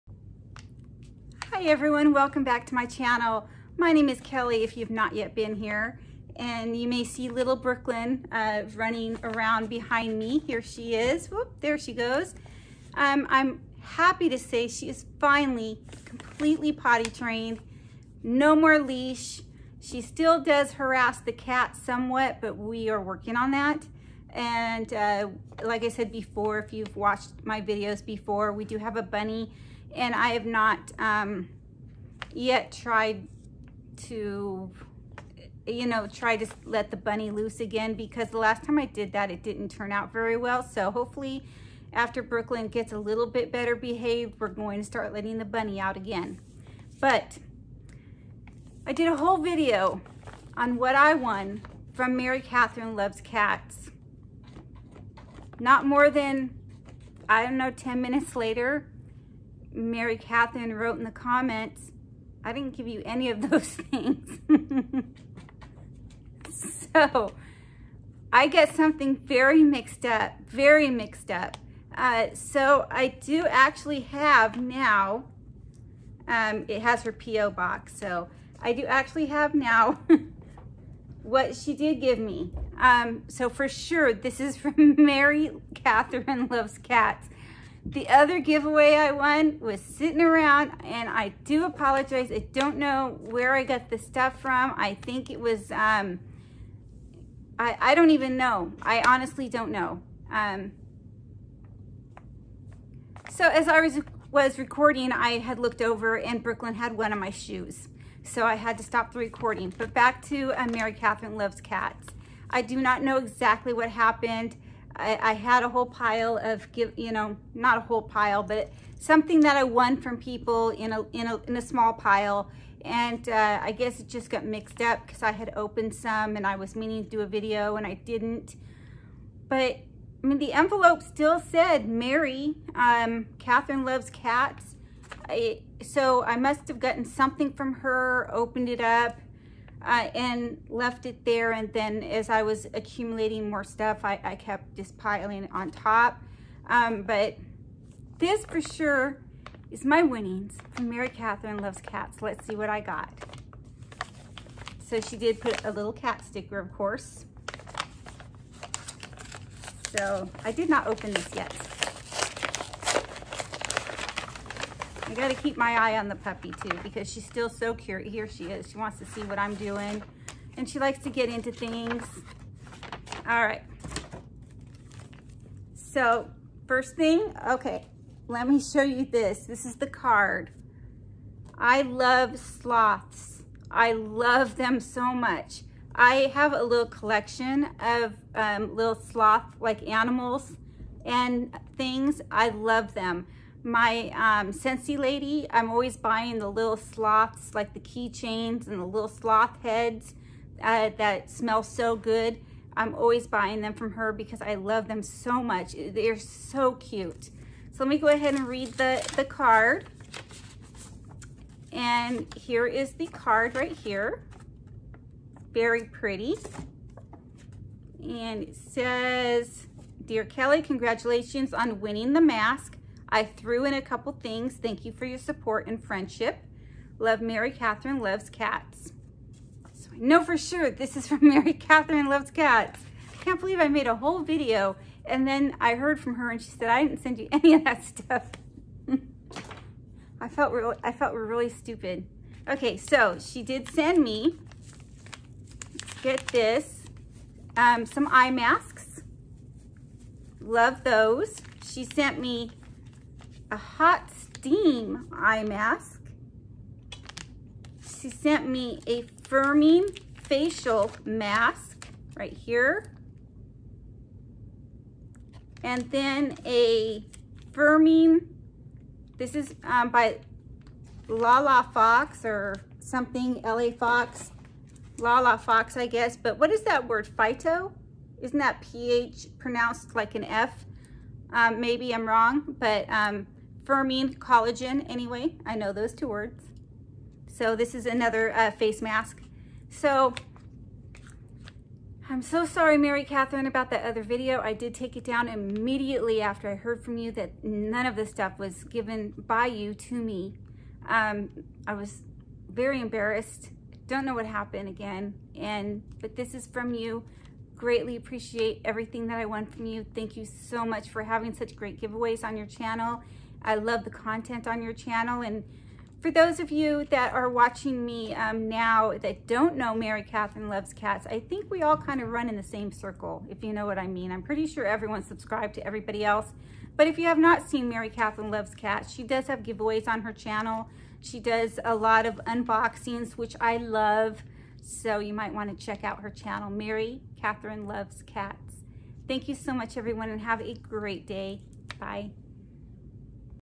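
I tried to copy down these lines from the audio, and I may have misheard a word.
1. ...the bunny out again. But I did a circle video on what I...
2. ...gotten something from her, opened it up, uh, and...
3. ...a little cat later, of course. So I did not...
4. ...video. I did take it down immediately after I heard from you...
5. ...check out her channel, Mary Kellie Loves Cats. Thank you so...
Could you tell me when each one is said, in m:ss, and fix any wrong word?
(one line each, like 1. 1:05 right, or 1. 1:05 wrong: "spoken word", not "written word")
1. 0:45 wrong: "whole", not "circle"
2. 2:16 right
3. 2:35 wrong: "sticker", not "later"
4. 4:54 right
5. 5:35 wrong: "Catherine", not "Kellie".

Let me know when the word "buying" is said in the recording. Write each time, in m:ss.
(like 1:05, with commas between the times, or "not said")
3:15, 3:23.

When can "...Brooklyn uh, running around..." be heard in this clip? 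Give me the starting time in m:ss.
0:07.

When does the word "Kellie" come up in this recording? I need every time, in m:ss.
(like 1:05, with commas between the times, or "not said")
0:04, 3:40.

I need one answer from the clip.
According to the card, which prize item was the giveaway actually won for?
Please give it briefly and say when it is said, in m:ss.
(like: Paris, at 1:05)
the mask, at 3:42.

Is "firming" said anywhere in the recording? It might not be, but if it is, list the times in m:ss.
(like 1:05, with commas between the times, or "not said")
4:19, 4:27, 4:43.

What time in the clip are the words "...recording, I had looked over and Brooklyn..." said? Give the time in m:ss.
1:44.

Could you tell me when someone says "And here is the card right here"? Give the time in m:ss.
3:31.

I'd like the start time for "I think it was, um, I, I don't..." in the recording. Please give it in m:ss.
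1:34.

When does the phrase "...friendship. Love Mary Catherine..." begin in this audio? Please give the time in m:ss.
3:45.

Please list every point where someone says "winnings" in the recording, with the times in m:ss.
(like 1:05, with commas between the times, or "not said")
2:30, 3:41.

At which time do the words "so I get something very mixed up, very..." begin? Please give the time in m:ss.
1:06.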